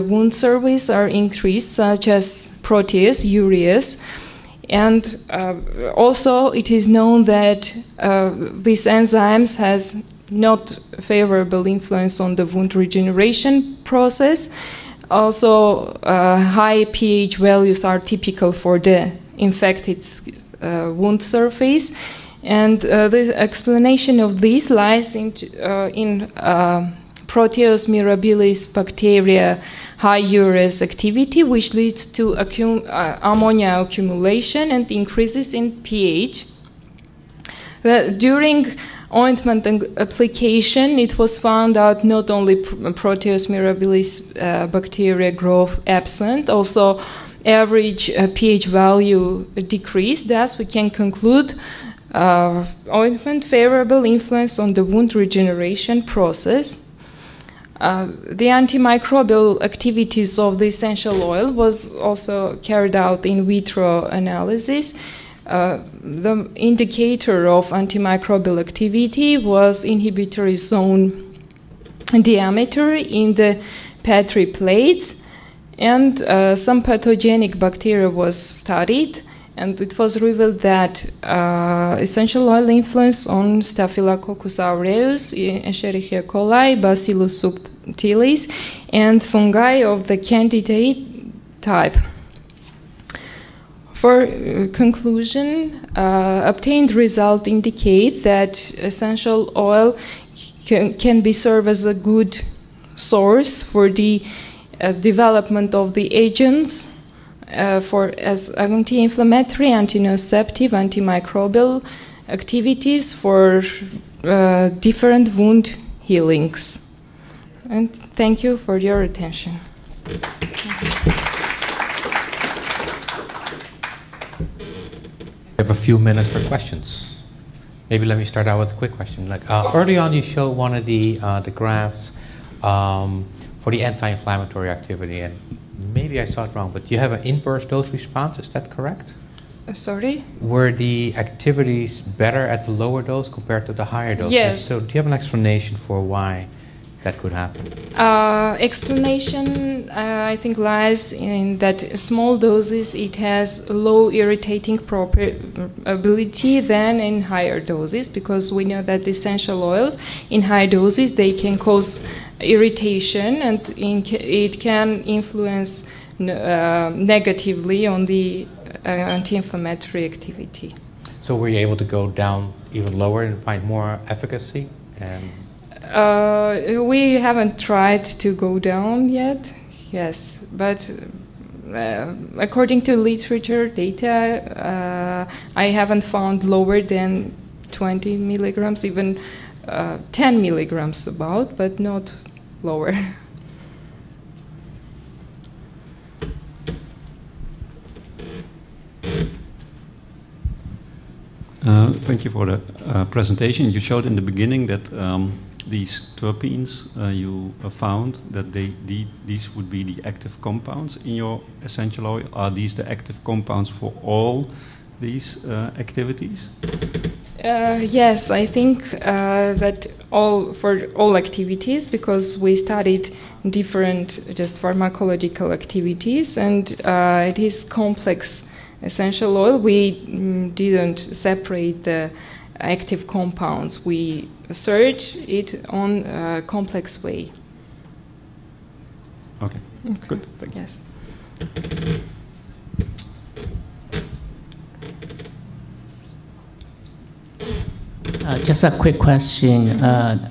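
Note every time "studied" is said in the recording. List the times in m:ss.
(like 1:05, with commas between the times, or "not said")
1:18, 3:42.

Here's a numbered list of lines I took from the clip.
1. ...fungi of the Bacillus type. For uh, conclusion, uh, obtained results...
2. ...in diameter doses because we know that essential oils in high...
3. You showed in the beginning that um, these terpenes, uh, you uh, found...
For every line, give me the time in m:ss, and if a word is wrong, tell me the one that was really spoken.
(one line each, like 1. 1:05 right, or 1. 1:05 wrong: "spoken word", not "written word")
1. 1:29 wrong: "Candida", not "Bacillus"
2. 2:37 wrong: "higher", not "diameter"
3. 3:23 right.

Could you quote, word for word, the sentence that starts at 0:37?
The, during ointment application, it was found out not only Proteus mirabilis uh, bacteria growth absent, also average uh, pH value decreased.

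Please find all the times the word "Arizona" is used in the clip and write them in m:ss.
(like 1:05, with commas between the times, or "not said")
not said.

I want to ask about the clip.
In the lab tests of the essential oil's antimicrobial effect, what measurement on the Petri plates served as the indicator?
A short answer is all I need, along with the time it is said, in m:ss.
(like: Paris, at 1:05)
Inhibitory zone diameter, at 1:09.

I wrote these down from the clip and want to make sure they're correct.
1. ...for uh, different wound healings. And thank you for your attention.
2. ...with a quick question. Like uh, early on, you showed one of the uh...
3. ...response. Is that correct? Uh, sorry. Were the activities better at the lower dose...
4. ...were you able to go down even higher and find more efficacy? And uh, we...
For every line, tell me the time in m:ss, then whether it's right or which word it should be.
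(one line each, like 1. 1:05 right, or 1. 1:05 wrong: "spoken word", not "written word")
1. 1:53 right
2. 2:08 right
3. 2:17 right
4. 2:51 wrong: "lower", not "higher".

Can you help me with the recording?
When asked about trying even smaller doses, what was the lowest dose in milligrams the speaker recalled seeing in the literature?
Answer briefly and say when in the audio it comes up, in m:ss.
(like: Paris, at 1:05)
10 milligrams, at 3:10.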